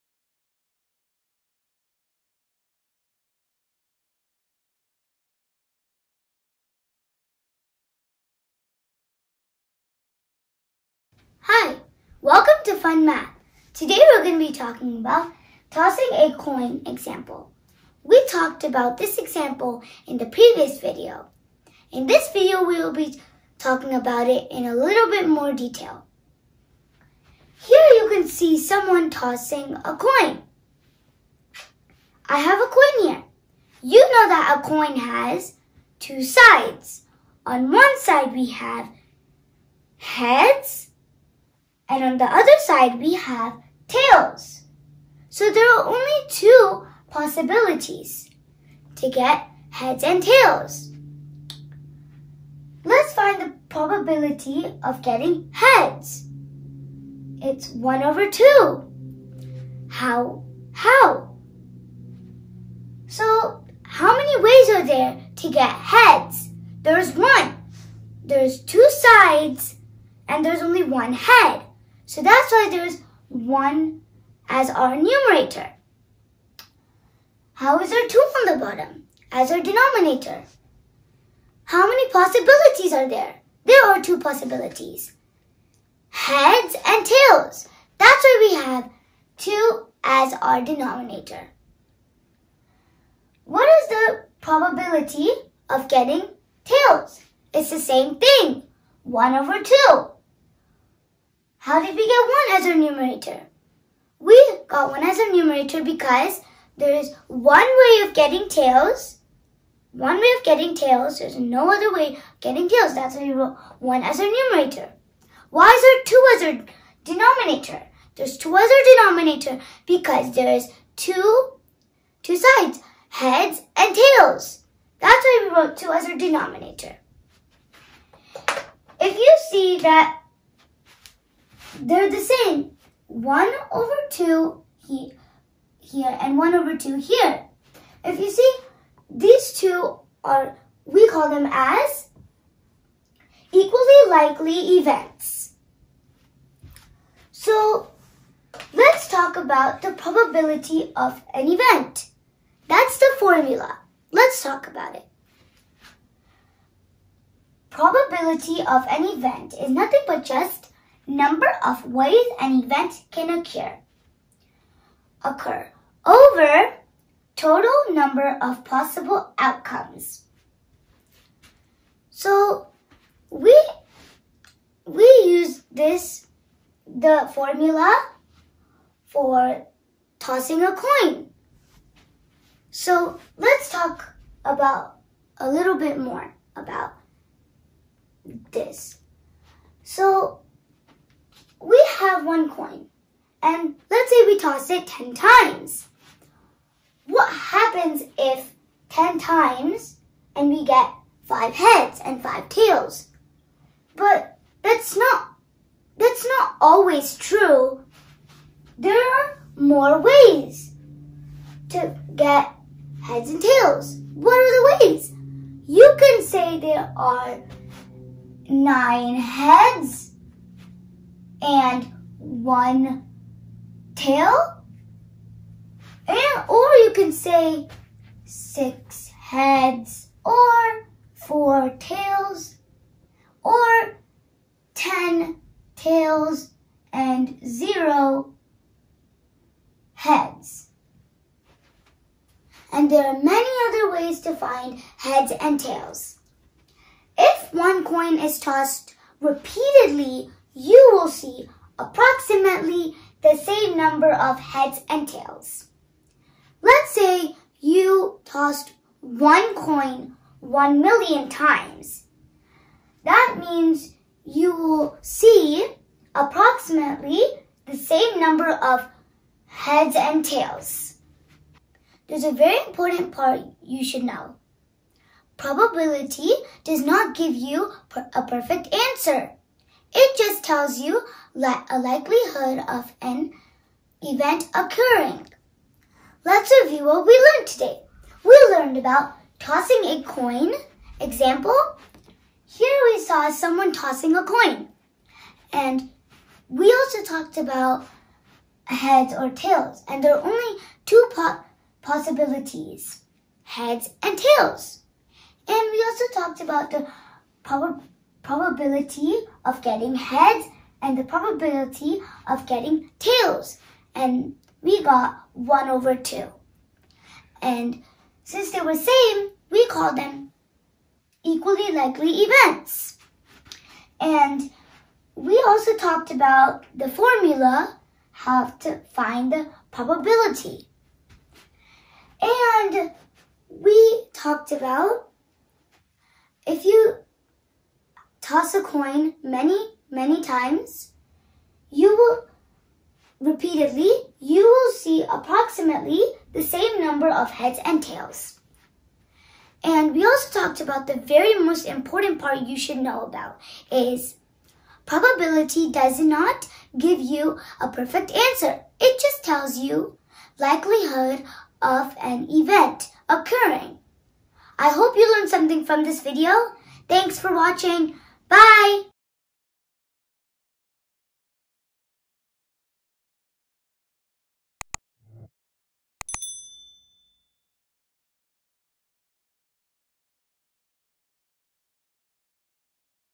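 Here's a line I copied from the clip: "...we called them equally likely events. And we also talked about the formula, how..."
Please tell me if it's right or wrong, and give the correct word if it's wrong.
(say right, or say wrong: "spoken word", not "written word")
right.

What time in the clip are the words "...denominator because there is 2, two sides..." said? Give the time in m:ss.
1:59.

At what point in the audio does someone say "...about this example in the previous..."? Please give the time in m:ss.
0:18.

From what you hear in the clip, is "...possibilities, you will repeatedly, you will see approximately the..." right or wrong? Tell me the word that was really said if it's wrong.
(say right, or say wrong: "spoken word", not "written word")
wrong: "times", not "possibilities".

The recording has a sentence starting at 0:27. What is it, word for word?
Here you can see someone tossing a coin.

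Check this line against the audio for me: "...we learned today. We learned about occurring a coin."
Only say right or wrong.
wrong.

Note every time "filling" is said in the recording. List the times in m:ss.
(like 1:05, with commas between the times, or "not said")
not said.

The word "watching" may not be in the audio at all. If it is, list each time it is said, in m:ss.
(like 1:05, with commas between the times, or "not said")
6:07.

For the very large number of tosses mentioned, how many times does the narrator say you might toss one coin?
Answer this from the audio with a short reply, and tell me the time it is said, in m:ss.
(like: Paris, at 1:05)
one million, at 4:20.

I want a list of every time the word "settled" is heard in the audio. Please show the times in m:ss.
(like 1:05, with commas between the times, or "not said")
not said.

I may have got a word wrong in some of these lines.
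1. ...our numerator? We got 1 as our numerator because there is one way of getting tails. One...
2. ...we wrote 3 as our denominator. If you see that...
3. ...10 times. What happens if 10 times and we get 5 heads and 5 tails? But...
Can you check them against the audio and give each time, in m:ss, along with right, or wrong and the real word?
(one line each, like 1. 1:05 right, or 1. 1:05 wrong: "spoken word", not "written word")
1. 1:42 right
2. 2:05 wrong: "2", not "3"
3. 3:14 right.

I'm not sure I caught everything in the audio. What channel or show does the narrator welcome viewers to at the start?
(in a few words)
Fun Math.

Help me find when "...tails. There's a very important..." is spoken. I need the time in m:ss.
4:30.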